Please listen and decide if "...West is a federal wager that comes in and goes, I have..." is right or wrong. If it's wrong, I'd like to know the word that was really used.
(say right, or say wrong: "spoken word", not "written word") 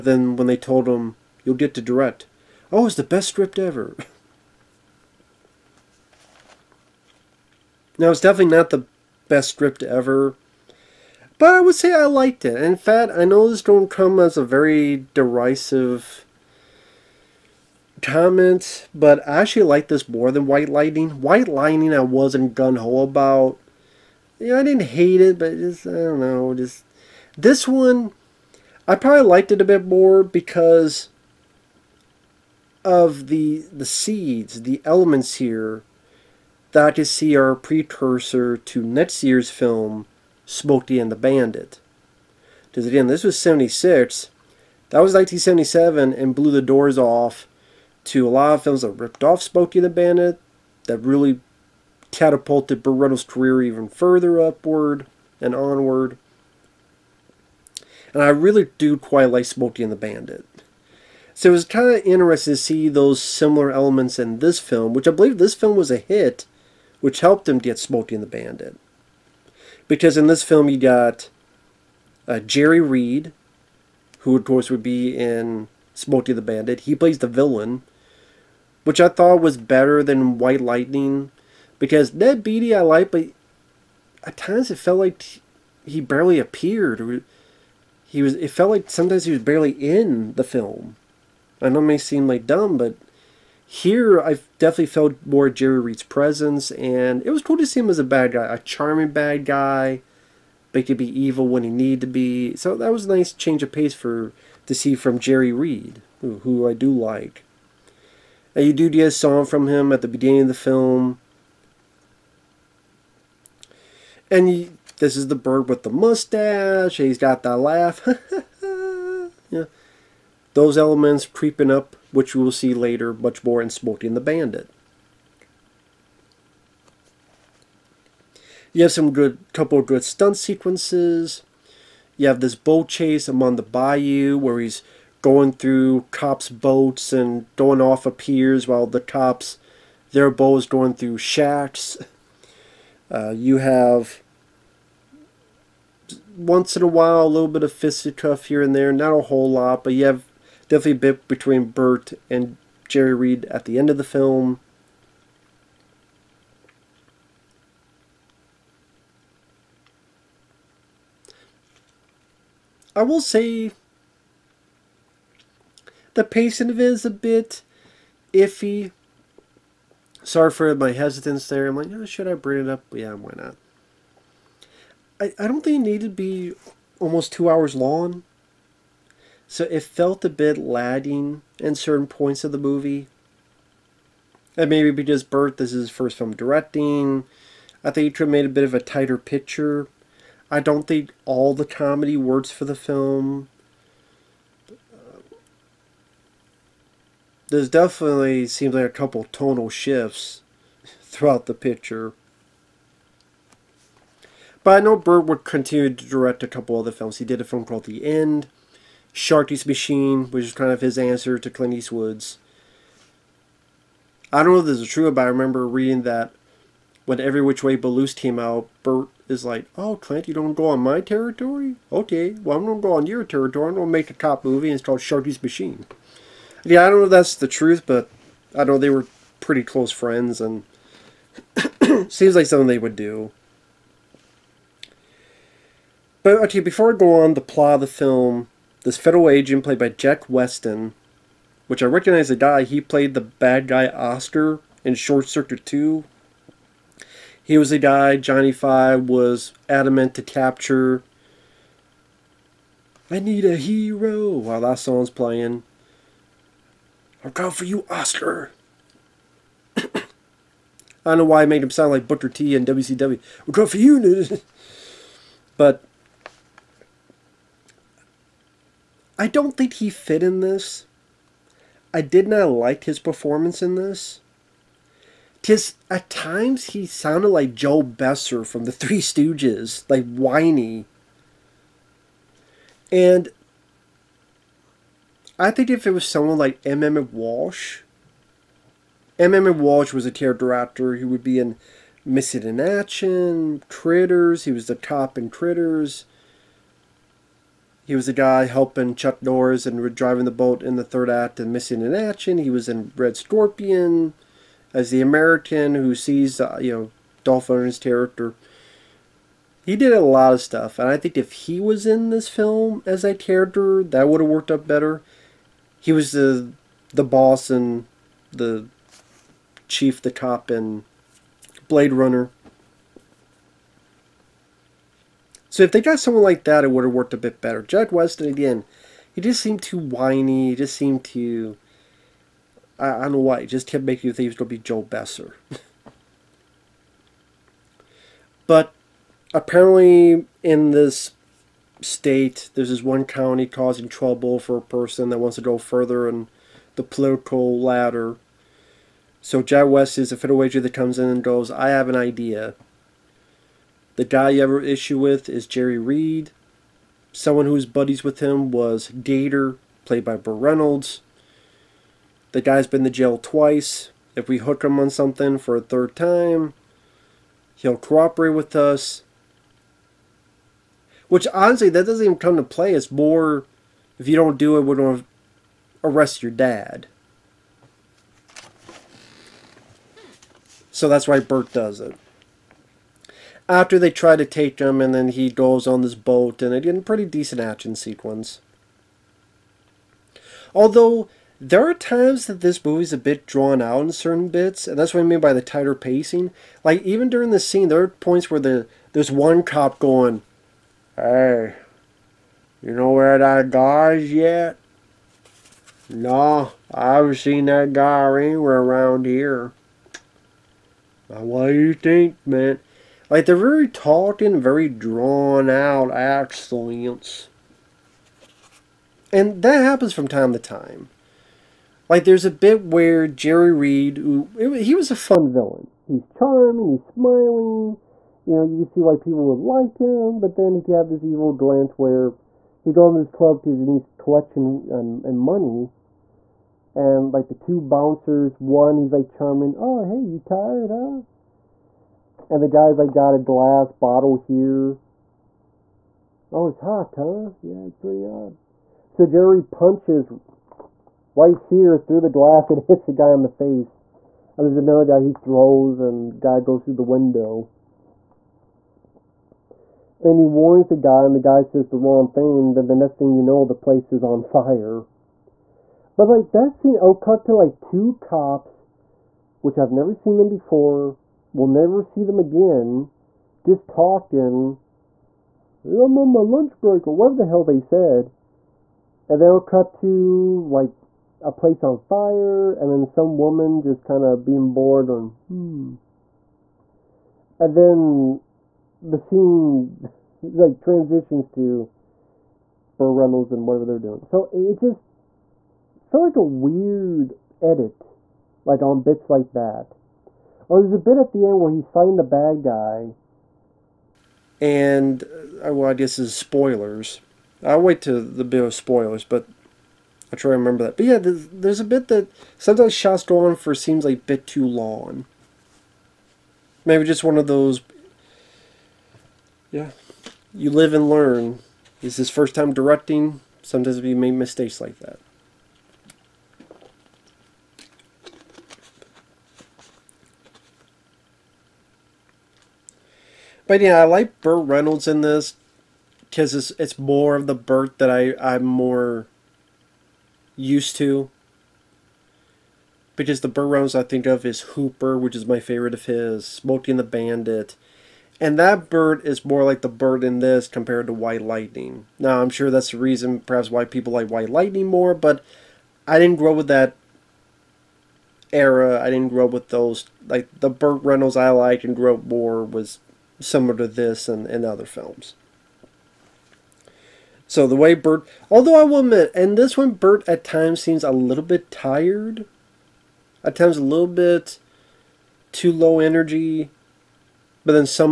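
right.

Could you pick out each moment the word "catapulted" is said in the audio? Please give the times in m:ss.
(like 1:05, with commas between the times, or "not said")
0:52.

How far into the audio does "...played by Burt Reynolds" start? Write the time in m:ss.
5:59.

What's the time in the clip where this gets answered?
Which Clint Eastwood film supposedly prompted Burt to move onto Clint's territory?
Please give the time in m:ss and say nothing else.
3:37.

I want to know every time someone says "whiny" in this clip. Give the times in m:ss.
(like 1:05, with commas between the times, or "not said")
4:40, 5:29.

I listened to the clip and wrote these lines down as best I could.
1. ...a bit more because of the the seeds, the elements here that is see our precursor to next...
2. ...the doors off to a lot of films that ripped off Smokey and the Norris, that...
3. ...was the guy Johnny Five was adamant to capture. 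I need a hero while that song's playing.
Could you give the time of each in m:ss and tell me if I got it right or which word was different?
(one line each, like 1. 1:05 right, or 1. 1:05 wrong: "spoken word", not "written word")
1. 0:29 right
2. 0:46 wrong: "Bandit", not "Norris"
3. 4:07 right.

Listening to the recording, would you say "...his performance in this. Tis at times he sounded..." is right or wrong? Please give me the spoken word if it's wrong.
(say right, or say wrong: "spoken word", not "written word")
right.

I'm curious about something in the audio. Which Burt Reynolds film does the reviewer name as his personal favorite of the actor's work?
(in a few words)
Hooper.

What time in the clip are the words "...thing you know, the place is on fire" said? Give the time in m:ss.
7:42.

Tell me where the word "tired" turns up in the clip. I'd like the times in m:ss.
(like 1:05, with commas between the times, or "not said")
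7:20, 9:31.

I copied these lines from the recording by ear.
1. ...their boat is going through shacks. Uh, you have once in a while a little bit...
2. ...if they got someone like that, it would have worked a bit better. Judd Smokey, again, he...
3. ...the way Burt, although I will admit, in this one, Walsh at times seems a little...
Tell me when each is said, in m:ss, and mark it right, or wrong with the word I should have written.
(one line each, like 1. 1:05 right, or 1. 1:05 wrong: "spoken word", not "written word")
1. 2:20 right
2. 5:25 wrong: "Weston", not "Smokey"
3. 9:27 wrong: "Burt", not "Walsh".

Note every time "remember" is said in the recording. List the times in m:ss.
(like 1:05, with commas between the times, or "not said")
3:35, 8:30.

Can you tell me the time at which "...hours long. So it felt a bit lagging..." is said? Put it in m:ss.
2:57.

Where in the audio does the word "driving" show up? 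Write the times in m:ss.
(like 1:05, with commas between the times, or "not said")
4:59.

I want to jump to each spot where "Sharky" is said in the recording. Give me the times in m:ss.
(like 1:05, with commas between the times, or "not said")
3:29, 3:44.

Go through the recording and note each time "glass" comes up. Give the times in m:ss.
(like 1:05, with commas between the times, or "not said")
7:23, 7:32.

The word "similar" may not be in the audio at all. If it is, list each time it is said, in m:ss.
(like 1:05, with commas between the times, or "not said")
1:03, 9:23.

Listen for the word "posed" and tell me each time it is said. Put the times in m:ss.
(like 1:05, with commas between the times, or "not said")
not said.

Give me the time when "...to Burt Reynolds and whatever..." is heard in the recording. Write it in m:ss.
8:11.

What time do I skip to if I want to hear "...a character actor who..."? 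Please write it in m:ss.
4:50.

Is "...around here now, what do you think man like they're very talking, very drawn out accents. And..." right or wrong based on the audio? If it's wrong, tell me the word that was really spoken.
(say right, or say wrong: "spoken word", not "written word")
right.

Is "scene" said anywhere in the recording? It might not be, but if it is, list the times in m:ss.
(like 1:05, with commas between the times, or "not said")
6:37, 7:46, 8:08.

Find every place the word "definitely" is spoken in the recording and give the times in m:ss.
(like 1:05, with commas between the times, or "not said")
0:08, 1:34, 2:30, 3:17.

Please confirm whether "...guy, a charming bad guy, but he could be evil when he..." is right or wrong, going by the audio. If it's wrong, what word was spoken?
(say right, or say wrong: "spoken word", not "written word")
right.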